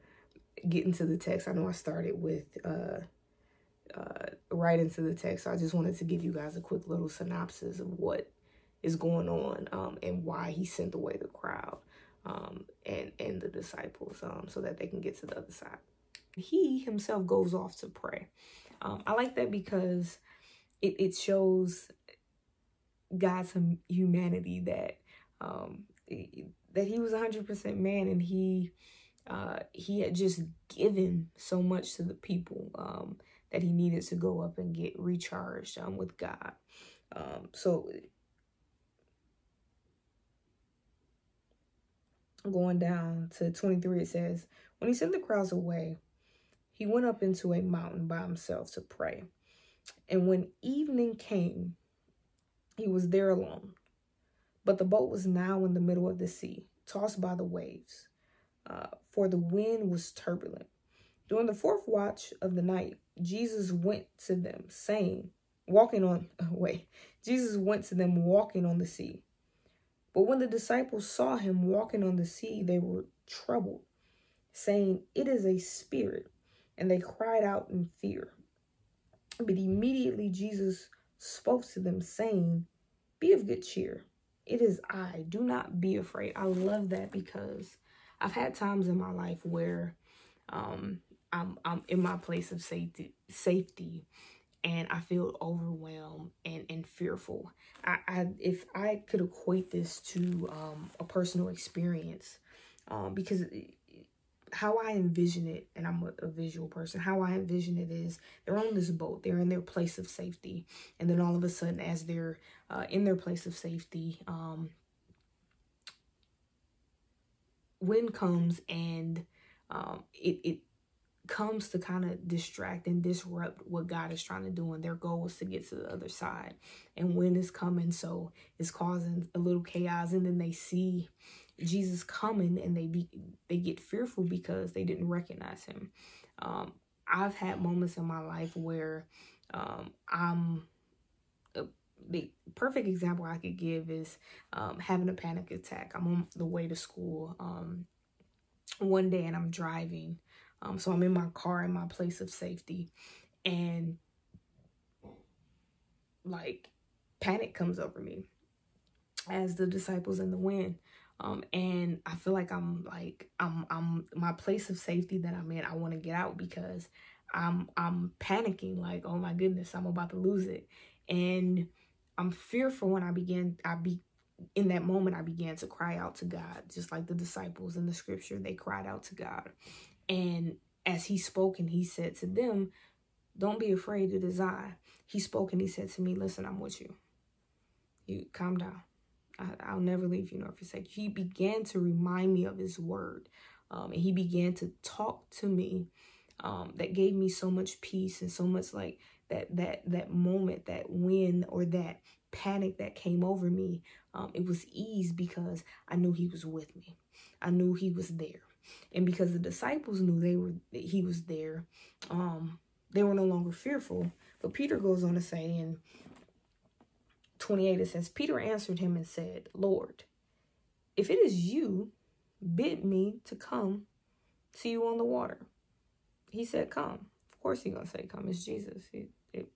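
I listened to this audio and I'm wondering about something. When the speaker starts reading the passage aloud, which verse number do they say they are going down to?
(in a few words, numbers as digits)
23.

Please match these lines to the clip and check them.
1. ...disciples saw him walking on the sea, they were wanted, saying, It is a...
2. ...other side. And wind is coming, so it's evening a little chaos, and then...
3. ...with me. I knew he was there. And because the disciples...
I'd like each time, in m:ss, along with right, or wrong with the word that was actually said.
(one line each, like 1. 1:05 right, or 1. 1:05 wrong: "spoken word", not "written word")
1. 1:10 wrong: "troubled", not "wanted"
2. 2:05 wrong: "causing", not "evening"
3. 3:26 right.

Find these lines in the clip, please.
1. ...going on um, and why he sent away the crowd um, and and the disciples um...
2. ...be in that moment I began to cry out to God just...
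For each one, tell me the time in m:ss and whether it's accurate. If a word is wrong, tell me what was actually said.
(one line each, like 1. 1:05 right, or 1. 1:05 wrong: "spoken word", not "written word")
1. 0:08 right
2. 2:53 right.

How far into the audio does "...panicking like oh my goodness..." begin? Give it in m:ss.
2:48.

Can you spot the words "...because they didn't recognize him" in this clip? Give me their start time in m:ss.
2:14.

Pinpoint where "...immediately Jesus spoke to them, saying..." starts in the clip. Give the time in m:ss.
1:19.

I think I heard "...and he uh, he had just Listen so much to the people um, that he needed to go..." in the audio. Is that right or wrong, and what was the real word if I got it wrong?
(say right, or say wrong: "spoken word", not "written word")
wrong: "given", not "Listen".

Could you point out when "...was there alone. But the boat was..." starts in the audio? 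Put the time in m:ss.
0:52.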